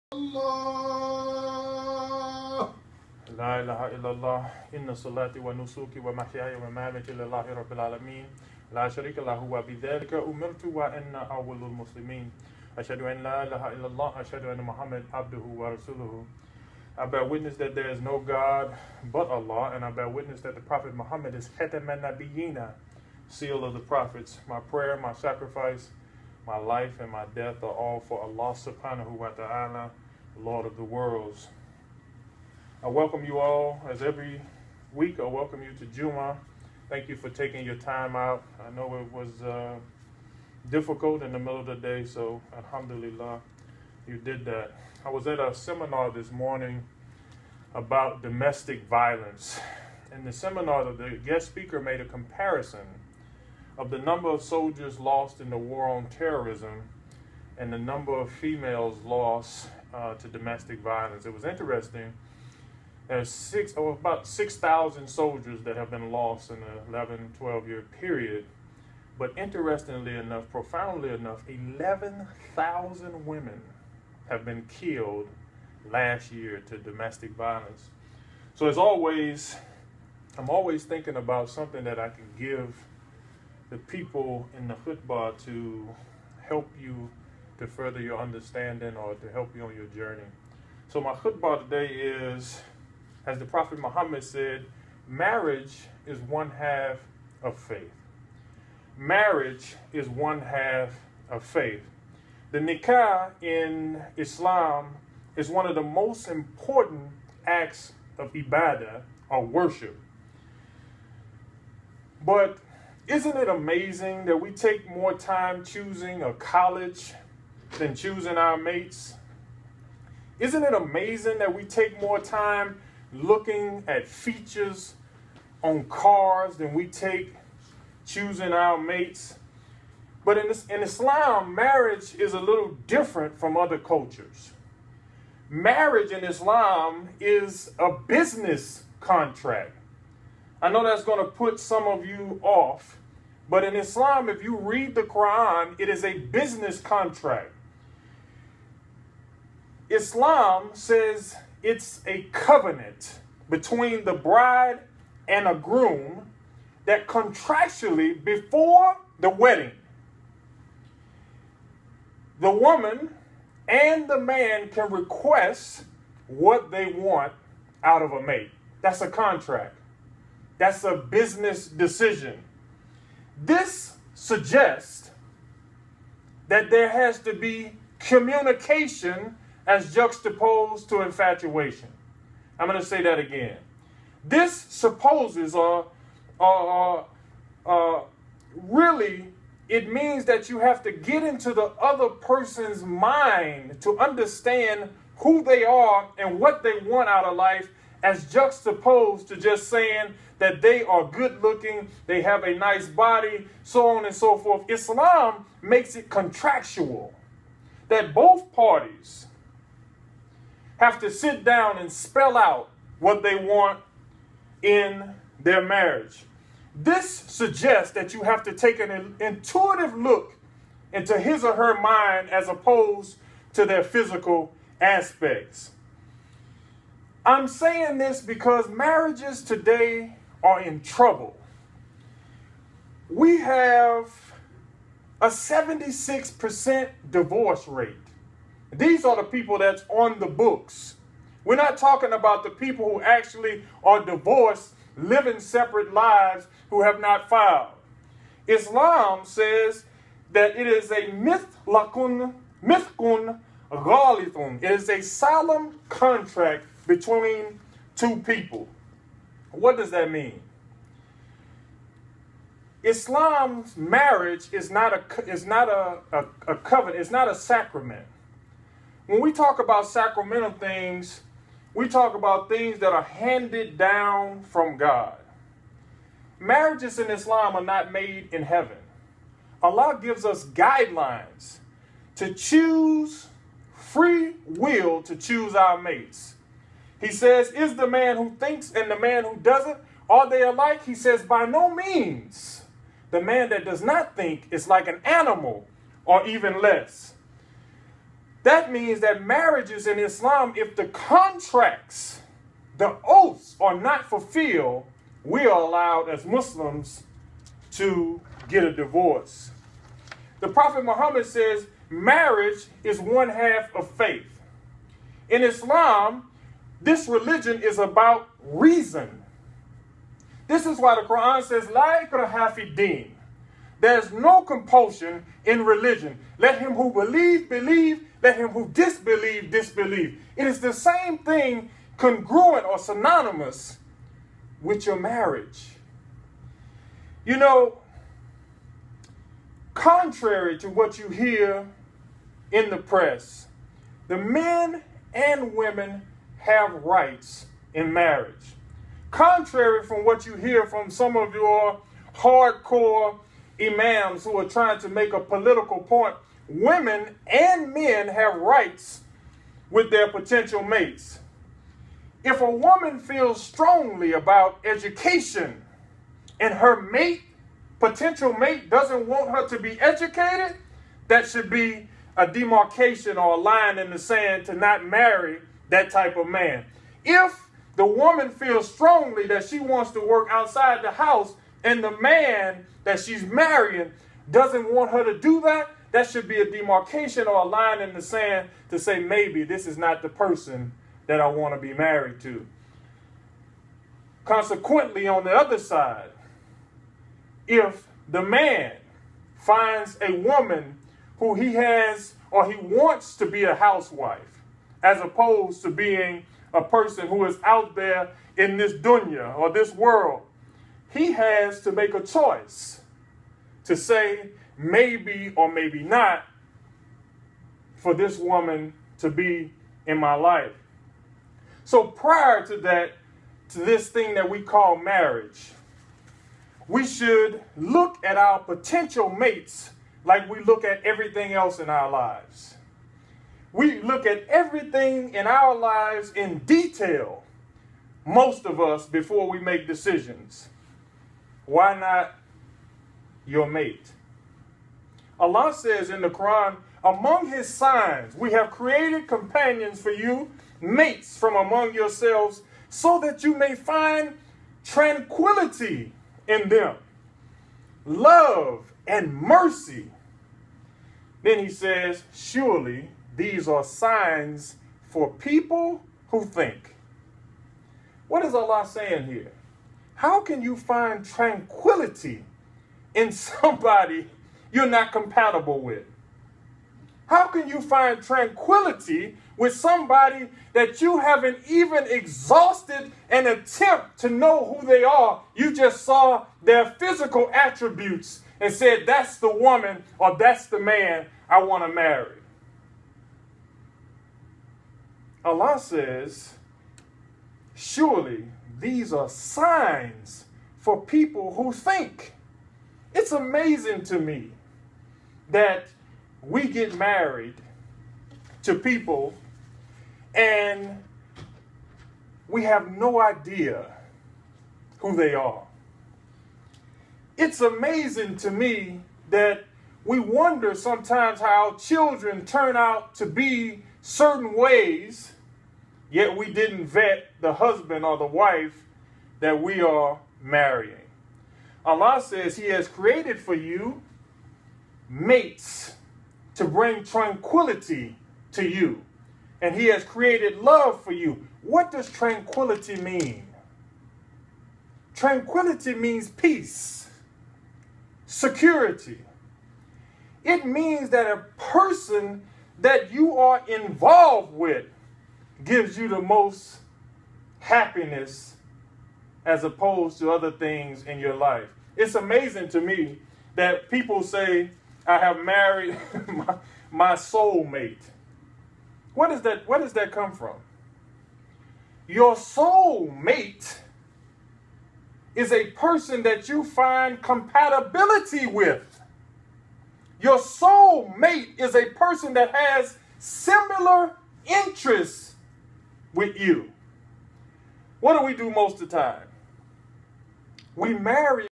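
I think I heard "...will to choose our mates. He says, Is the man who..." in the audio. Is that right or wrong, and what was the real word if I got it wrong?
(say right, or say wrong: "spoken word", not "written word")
right.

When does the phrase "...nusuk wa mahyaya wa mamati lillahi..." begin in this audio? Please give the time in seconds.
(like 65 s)
5 s.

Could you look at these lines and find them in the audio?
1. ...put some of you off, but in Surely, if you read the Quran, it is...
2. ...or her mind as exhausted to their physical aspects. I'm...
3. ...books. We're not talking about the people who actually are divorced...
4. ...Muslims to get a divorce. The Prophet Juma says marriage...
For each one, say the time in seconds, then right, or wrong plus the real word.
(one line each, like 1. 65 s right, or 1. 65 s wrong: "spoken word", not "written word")
1. 141 s wrong: "Islam", not "Surely"
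2. 221 s wrong: "opposed", not "exhausted"
3. 240 s right
4. 306 s wrong: "Muhammad", not "Juma".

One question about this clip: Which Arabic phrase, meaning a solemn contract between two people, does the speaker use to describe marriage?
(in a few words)
mithkun ghalithun.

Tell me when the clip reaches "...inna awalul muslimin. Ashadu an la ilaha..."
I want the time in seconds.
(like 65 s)
10 s.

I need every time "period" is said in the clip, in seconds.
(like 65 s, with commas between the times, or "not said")
67 s.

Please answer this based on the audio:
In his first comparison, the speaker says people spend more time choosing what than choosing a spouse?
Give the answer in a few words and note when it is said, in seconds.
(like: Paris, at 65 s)
a college, at 116 s.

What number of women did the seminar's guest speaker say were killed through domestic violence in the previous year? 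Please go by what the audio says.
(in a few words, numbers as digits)
11,000.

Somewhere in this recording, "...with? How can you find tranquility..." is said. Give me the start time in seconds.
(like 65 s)
475 s.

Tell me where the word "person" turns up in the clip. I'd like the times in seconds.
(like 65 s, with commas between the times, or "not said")
192 s, 390 s, 406 s, 551 s, 575 s, 581 s.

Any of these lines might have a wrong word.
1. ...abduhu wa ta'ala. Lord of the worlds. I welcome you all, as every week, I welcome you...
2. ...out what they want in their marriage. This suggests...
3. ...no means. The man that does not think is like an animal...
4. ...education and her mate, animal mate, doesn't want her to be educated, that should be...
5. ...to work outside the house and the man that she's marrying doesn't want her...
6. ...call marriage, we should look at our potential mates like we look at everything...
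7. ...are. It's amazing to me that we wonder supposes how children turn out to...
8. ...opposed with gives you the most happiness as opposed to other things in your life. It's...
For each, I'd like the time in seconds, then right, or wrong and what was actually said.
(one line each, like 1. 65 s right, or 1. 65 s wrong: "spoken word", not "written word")
1. 28 s wrong: "subhanahu", not "abduhu"
2. 212 s right
3. 291 s right
4. 364 s wrong: "potential", not "animal"
5. 379 s right
6. 424 s right
7. 515 s wrong: "sometimes", not "supposes"
8. 553 s wrong: "involved", not "opposed".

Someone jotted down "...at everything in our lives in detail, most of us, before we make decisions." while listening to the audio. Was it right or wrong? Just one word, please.
right.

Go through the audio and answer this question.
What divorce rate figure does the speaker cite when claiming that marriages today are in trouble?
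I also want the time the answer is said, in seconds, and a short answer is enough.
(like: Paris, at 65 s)
76%, at 235 s.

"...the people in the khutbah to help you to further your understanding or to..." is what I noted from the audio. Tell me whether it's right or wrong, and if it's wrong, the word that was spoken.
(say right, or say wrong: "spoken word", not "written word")
right.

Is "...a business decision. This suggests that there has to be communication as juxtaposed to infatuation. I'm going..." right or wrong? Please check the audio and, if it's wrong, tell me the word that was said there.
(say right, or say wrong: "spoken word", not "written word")
right.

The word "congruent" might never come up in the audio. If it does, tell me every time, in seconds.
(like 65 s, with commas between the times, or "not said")
331 s.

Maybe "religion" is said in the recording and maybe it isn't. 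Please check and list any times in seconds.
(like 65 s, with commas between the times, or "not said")
317 s, 325 s.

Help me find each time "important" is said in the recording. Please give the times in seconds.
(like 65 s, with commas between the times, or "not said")
106 s.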